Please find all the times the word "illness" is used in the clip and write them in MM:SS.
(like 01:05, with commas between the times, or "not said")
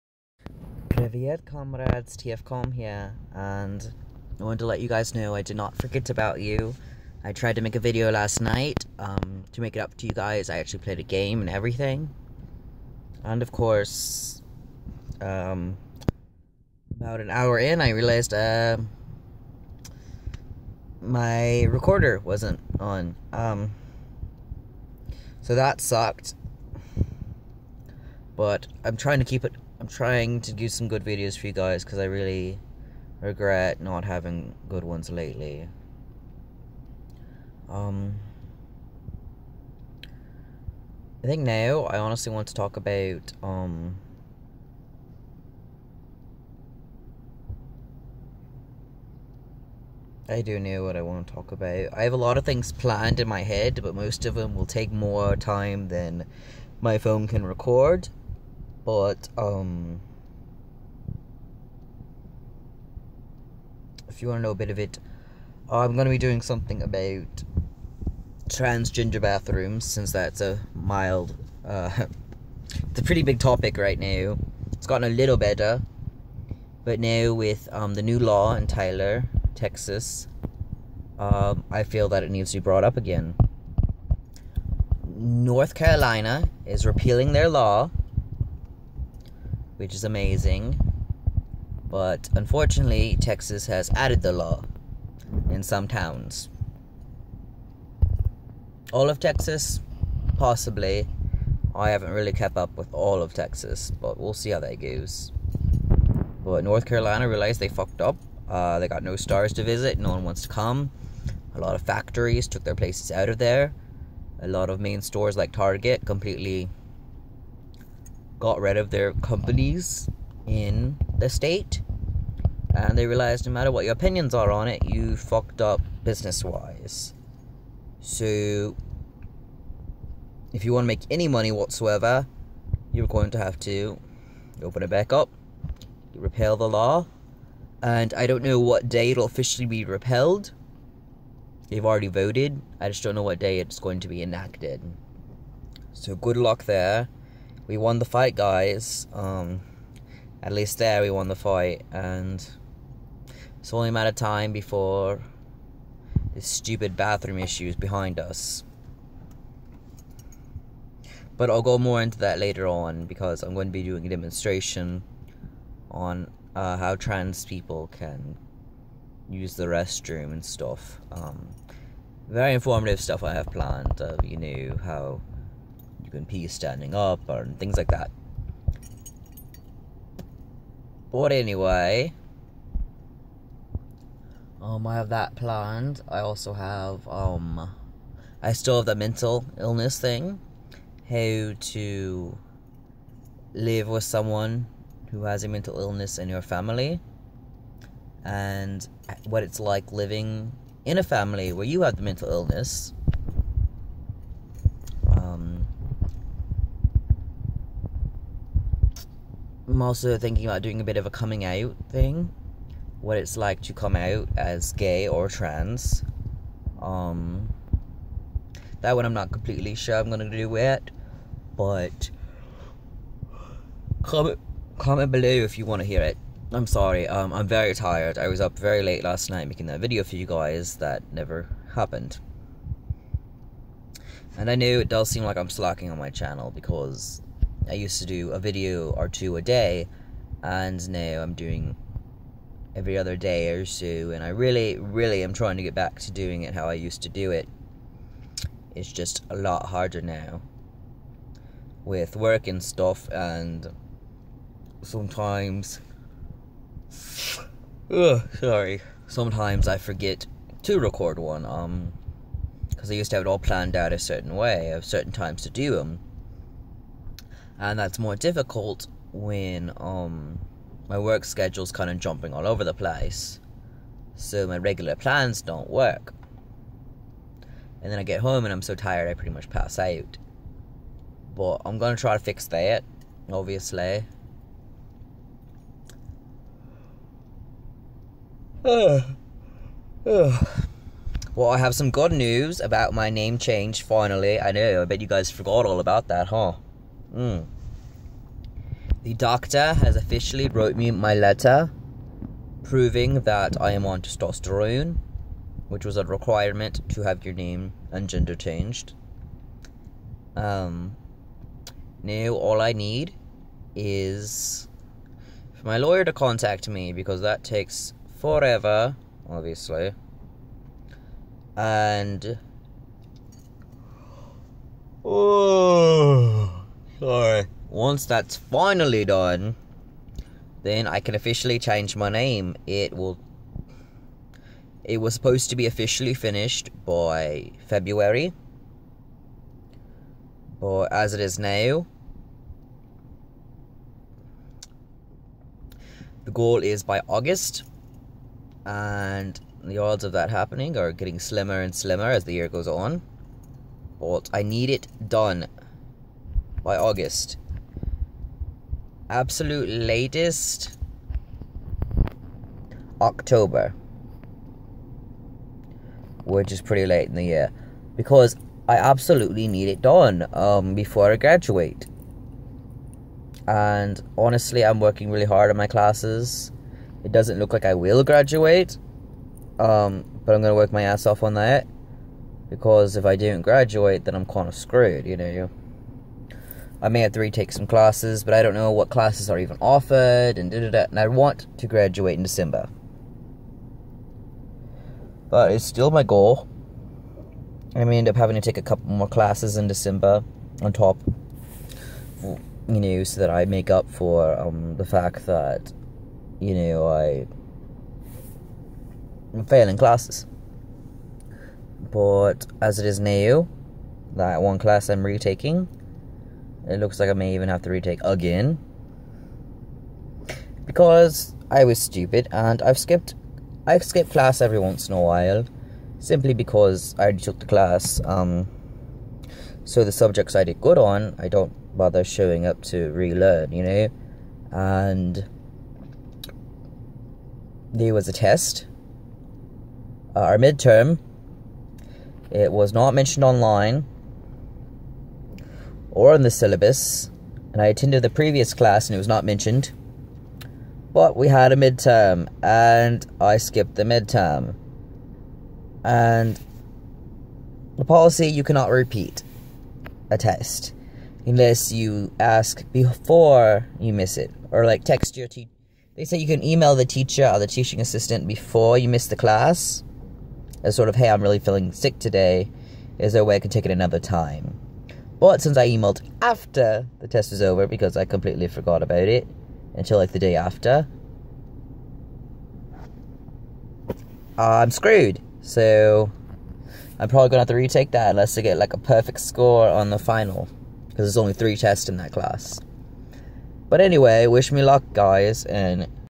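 03:09, 03:15, 03:22.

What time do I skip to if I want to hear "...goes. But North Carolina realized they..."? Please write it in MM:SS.
01:44.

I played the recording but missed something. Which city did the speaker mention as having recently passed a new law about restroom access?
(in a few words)
Tyler, Texas.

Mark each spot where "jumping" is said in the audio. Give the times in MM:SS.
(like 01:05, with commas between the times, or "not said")
04:31.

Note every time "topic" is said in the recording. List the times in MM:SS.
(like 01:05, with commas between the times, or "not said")
01:13.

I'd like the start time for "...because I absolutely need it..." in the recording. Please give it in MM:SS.
06:07.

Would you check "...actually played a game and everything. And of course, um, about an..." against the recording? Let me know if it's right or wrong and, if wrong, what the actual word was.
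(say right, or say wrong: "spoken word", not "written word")
right.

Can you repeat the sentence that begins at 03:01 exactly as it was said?
But anyway, um, I have that planned.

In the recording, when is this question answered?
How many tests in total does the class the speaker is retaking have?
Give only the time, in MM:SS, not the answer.
08:11.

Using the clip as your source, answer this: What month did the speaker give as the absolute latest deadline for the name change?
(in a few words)
October.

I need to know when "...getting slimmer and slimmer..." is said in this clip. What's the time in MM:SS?
05:50.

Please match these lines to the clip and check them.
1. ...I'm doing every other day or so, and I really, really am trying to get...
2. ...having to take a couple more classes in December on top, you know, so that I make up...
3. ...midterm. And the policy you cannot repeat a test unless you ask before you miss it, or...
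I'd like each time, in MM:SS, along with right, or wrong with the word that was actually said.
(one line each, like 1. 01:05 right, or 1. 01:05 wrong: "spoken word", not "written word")
1. 04:01 right
2. 06:38 right
3. 07:33 right.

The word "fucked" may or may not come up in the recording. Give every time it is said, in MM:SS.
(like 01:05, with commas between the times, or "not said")
01:47, 02:05.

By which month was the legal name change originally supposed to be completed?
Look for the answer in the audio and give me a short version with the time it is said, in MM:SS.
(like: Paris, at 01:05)
February, at 05:37.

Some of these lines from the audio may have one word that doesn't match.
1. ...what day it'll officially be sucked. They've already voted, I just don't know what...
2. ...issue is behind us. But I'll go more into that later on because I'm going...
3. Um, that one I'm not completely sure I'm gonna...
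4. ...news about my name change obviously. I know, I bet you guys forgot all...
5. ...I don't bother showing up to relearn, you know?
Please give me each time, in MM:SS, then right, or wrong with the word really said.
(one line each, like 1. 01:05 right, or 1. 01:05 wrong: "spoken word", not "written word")
1. 02:18 wrong: "repealed", not "sucked"
2. 02:37 right
3. 03:36 right
4. 04:52 wrong: "finally", not "obviously"
5. 07:11 right.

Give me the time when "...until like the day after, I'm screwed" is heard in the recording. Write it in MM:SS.
07:59.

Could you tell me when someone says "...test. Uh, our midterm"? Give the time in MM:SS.
07:18.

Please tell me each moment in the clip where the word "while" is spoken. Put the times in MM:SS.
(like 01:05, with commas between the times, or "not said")
07:05.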